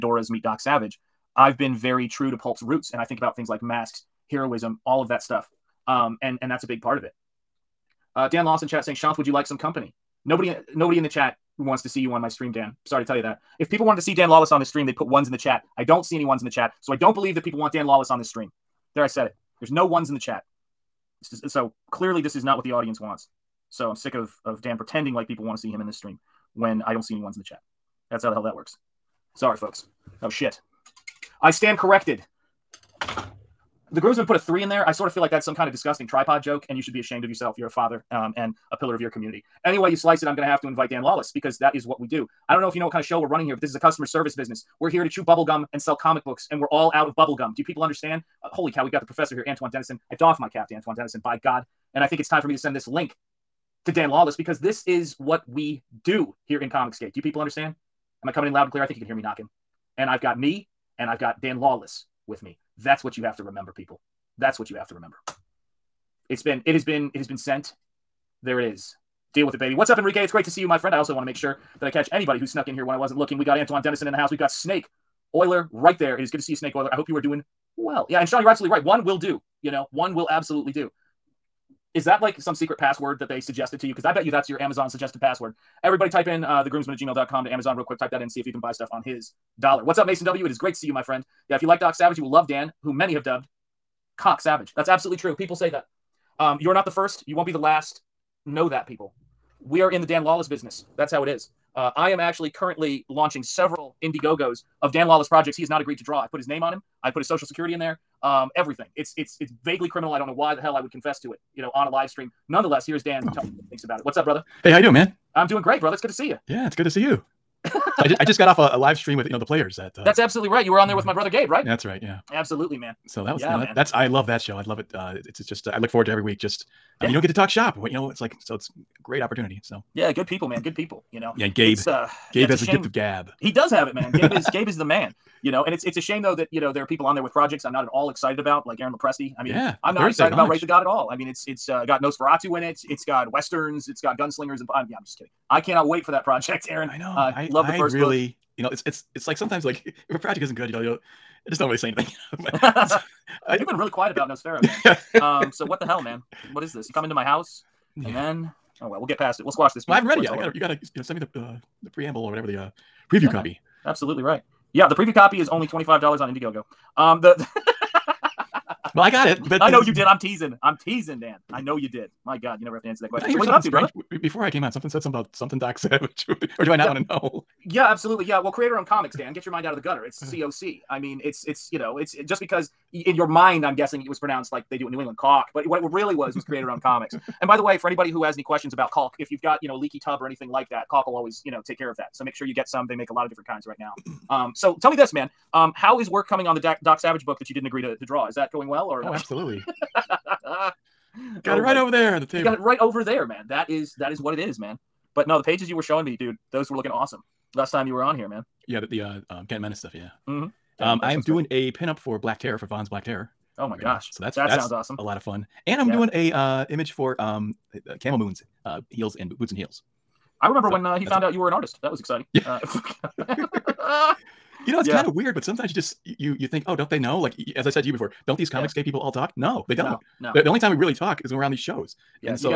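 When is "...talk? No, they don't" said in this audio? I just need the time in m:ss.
3:49.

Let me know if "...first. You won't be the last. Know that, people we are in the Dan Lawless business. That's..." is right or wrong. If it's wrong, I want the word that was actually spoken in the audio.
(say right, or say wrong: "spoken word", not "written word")
right.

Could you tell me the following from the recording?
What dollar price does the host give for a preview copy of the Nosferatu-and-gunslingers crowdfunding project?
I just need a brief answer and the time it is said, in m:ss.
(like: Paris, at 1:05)
$25, at 2:45.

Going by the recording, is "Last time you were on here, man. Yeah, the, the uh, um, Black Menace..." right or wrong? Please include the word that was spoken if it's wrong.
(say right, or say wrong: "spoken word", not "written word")
wrong: "Kent", not "Black".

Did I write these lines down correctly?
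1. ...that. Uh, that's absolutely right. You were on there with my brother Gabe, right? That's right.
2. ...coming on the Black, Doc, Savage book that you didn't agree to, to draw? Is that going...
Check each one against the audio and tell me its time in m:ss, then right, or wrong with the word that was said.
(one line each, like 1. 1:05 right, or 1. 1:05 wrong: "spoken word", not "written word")
1. 1:59 right
2. 3:16 wrong: "Doc", not "Black".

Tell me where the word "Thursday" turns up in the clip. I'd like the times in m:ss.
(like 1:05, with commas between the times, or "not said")
2:19.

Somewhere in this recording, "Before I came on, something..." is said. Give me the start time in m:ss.
2:54.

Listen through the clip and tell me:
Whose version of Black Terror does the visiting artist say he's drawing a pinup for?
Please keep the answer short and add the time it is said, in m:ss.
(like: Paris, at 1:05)
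Vaughn, at 3:32.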